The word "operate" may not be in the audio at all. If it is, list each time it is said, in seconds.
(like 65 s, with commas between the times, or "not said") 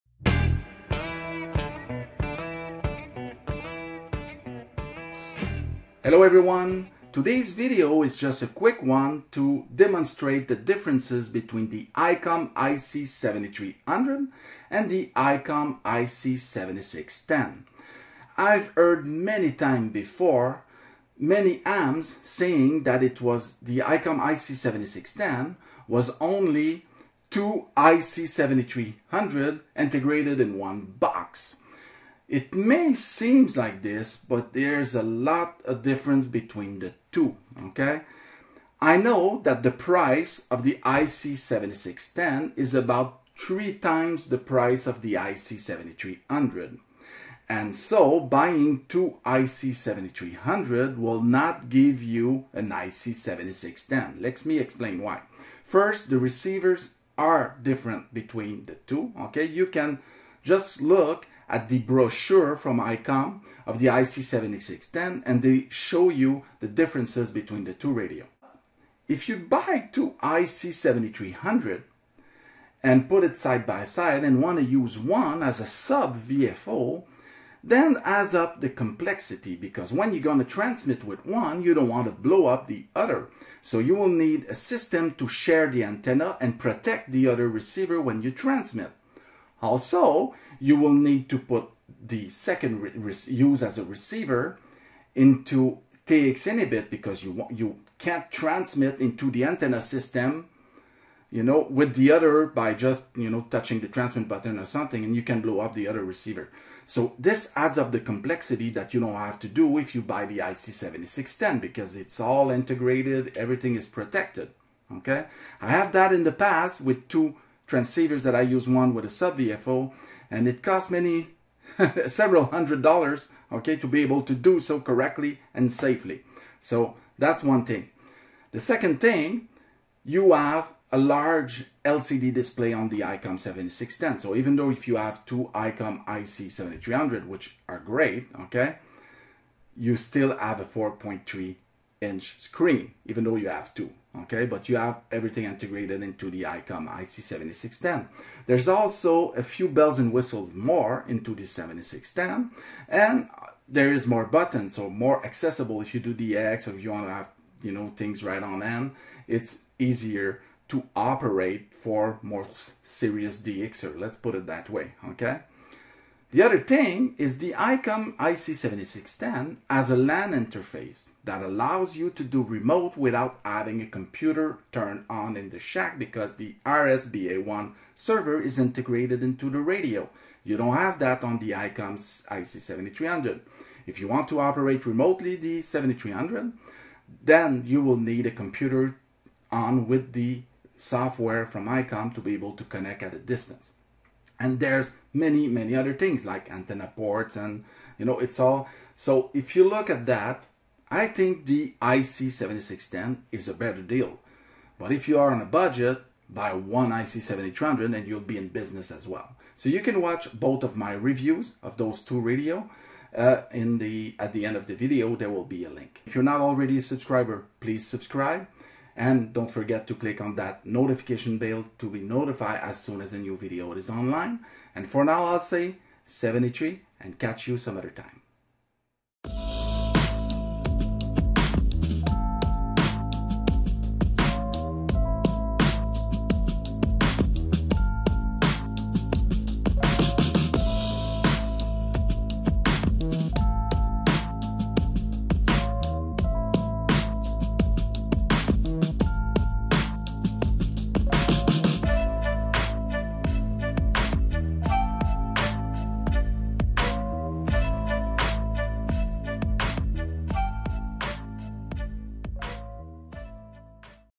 160 s, 184 s.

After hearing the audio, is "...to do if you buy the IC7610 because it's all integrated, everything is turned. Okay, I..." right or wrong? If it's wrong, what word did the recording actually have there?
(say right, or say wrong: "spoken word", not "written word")
wrong: "protected", not "turned".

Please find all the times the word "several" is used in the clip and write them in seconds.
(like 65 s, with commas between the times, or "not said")
122 s.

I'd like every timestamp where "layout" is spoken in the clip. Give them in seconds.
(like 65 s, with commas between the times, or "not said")
not said.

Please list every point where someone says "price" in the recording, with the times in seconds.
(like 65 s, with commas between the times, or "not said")
39 s, 44 s.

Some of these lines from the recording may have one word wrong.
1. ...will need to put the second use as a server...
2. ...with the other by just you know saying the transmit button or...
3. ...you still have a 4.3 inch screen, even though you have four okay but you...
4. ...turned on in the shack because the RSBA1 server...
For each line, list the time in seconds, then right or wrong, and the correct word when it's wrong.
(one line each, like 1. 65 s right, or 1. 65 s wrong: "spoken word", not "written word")
1. 90 s wrong: "receiver", not "server"
2. 101 s wrong: "touching", not "saying"
3. 139 s wrong: "two", not "four"
4. 174 s right.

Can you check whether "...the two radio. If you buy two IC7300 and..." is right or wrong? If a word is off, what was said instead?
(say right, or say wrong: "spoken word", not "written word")
right.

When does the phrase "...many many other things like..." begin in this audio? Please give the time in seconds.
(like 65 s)
195 s.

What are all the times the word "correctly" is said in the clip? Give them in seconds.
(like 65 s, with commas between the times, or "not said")
124 s.